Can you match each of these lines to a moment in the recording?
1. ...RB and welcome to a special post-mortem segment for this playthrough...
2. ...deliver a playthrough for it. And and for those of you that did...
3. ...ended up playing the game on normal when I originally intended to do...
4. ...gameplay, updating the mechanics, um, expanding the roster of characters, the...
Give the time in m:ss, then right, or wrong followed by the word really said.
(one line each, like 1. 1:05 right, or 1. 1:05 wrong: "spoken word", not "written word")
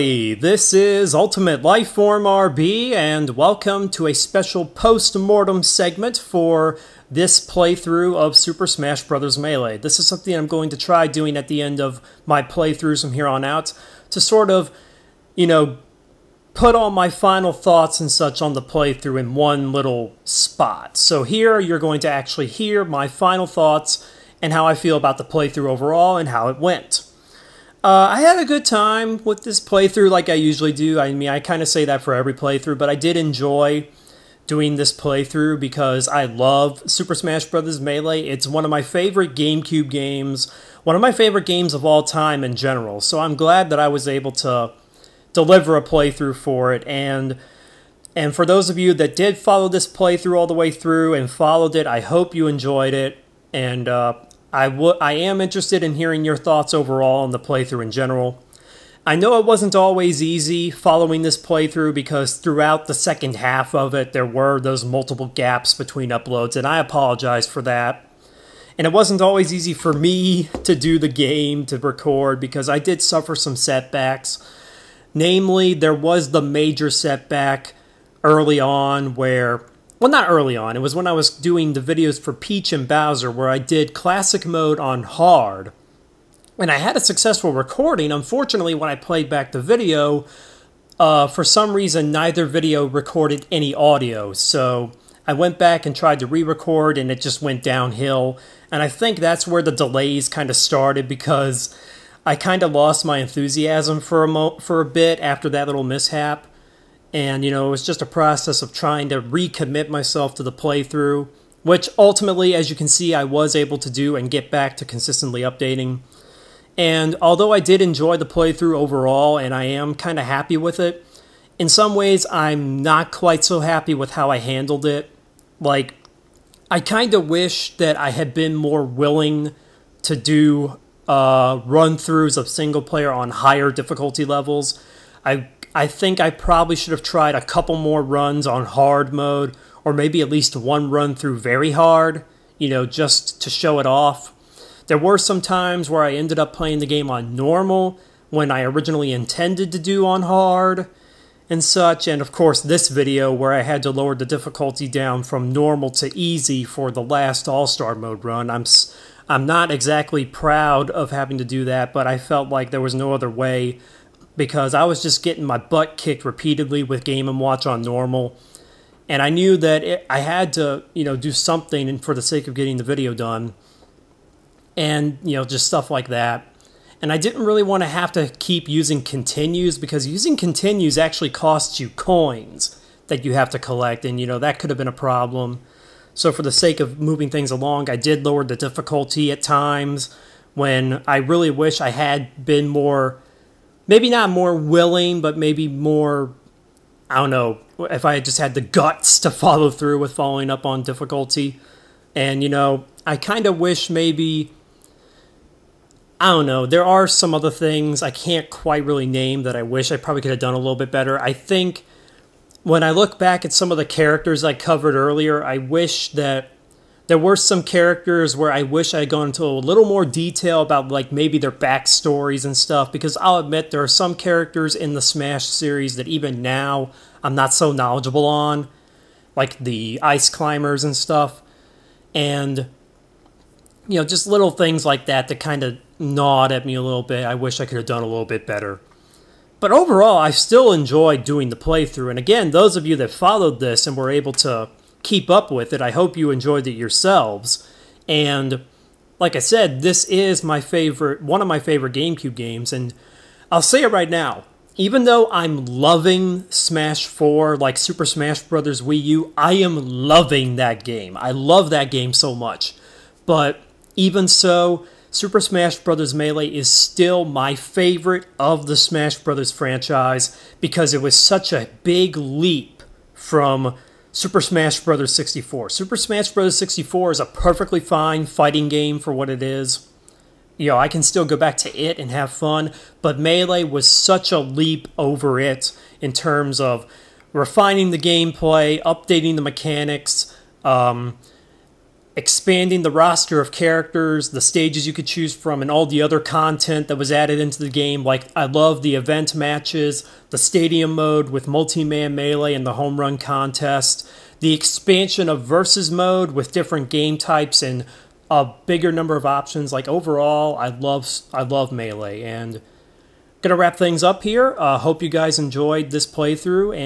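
1. 0:02 right
2. 0:45 right
3. 2:26 right
4. 4:47 right.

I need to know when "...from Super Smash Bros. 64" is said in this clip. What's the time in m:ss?
4:33.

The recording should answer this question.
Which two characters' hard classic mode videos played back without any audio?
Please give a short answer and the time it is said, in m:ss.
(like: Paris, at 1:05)
Peach and Bowser, at 1:22.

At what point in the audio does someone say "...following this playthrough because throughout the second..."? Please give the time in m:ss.
1:00.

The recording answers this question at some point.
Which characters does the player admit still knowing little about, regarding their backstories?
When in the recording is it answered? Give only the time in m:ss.
3:50.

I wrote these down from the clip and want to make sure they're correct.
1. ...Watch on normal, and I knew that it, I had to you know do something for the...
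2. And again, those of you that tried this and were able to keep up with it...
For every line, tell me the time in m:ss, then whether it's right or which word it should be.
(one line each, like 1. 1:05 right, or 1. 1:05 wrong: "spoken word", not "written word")
1. 2:47 right
2. 4:02 wrong: "followed", not "tried".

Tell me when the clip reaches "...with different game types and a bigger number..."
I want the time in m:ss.
5:06.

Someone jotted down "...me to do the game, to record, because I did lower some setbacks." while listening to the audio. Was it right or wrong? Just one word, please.
wrong.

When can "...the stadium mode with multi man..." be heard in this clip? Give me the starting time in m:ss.
5:00.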